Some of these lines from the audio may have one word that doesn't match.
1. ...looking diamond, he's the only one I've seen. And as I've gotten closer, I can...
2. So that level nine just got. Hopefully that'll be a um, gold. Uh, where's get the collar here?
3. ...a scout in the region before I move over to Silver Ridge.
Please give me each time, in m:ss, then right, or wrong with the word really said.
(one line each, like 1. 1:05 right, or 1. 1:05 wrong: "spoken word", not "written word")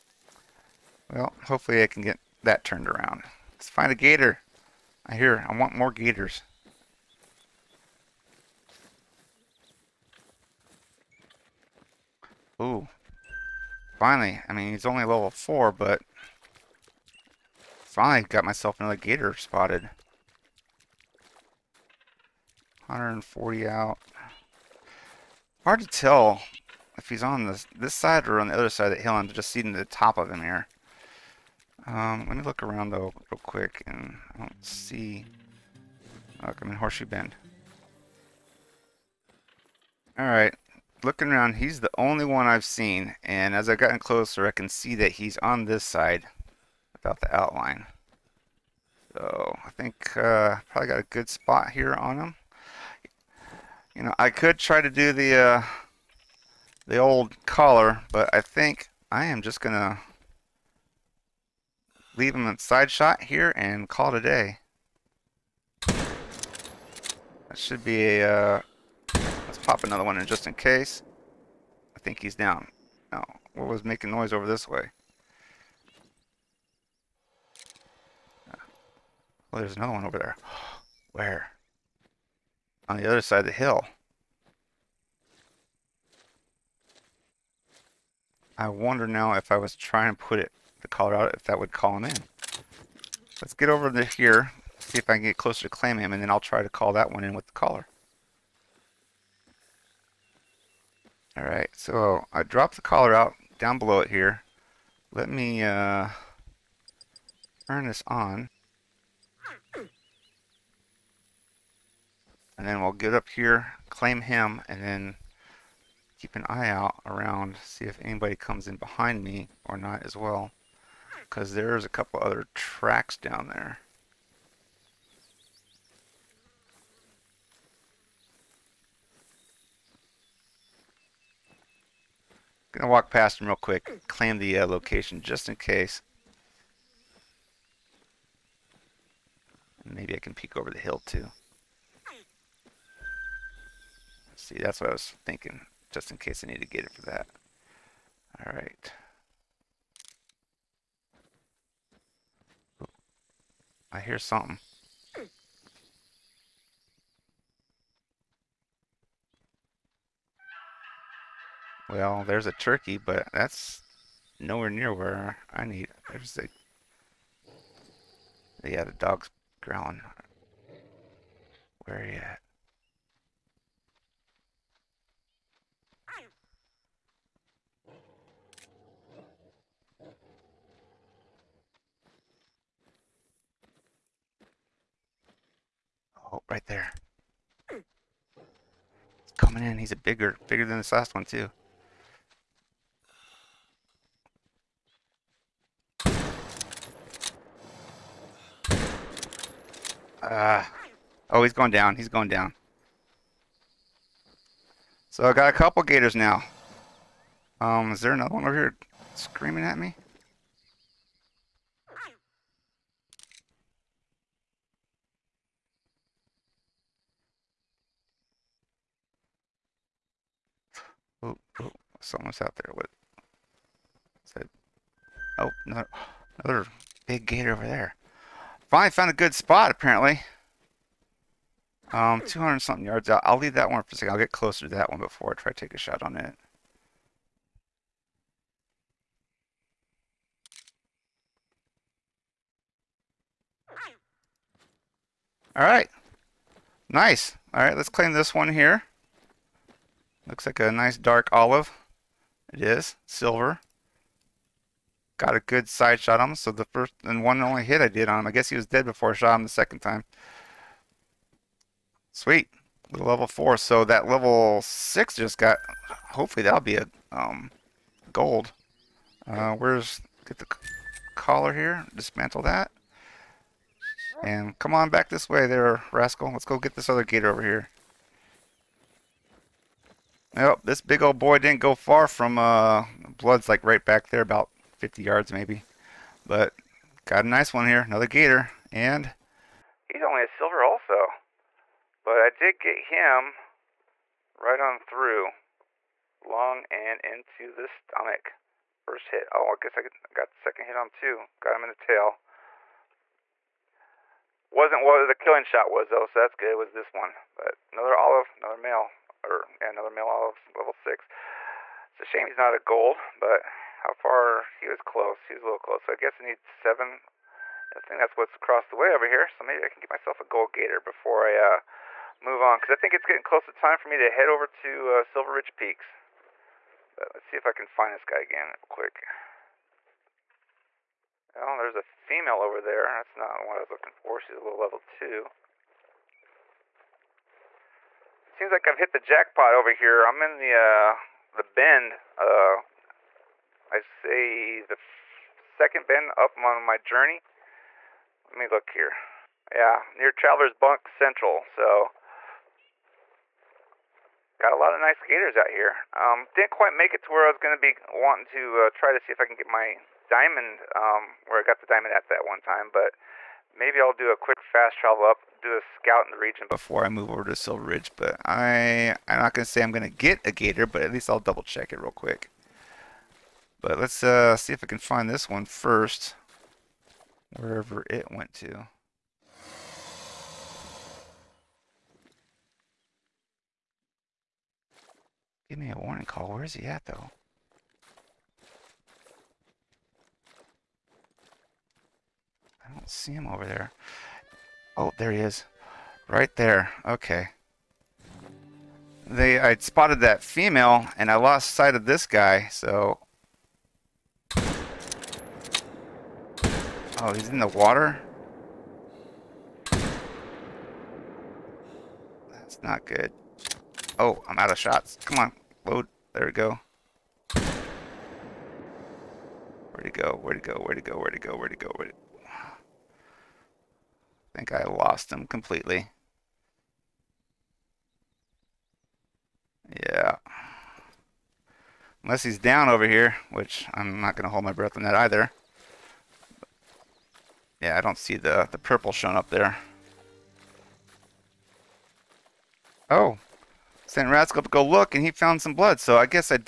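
1. 0:41 wrong: "around", not "diamond"
2. 4:23 wrong: "six", not "nine"
3. 6:05 right.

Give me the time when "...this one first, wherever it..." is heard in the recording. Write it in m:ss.
6:15.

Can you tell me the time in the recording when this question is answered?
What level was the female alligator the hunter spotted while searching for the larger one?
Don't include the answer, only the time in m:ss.
5:34.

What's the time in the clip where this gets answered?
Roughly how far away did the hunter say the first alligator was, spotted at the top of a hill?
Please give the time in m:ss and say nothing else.
0:22.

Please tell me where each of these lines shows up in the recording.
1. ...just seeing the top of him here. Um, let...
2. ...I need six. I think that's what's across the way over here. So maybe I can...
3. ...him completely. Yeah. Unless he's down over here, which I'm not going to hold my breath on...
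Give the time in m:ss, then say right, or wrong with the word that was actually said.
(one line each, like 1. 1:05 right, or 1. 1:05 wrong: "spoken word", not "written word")
1. 0:29 right
2. 5:16 wrong: "seven", not "six"
3. 7:05 right.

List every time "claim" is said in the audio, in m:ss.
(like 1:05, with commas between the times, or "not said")
1:35, 1:53, 2:14, 4:07.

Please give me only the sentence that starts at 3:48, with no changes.
Finally found a good spot, apparently.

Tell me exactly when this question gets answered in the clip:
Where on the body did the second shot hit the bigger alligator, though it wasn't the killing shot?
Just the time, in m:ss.
5:01.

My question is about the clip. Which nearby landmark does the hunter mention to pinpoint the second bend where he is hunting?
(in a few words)
Traveler's Bunk Central.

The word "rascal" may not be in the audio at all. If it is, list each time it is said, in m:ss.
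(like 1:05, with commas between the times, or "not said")
4:35, 7:24.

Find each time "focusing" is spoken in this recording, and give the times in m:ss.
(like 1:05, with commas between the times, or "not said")
not said.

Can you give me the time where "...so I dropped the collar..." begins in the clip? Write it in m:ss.
1:41.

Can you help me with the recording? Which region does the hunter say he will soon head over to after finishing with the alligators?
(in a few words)
Silver Ridge Peaks.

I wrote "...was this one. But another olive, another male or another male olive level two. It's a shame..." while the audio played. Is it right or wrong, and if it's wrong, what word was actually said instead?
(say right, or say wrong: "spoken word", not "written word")
wrong: "six", not "two".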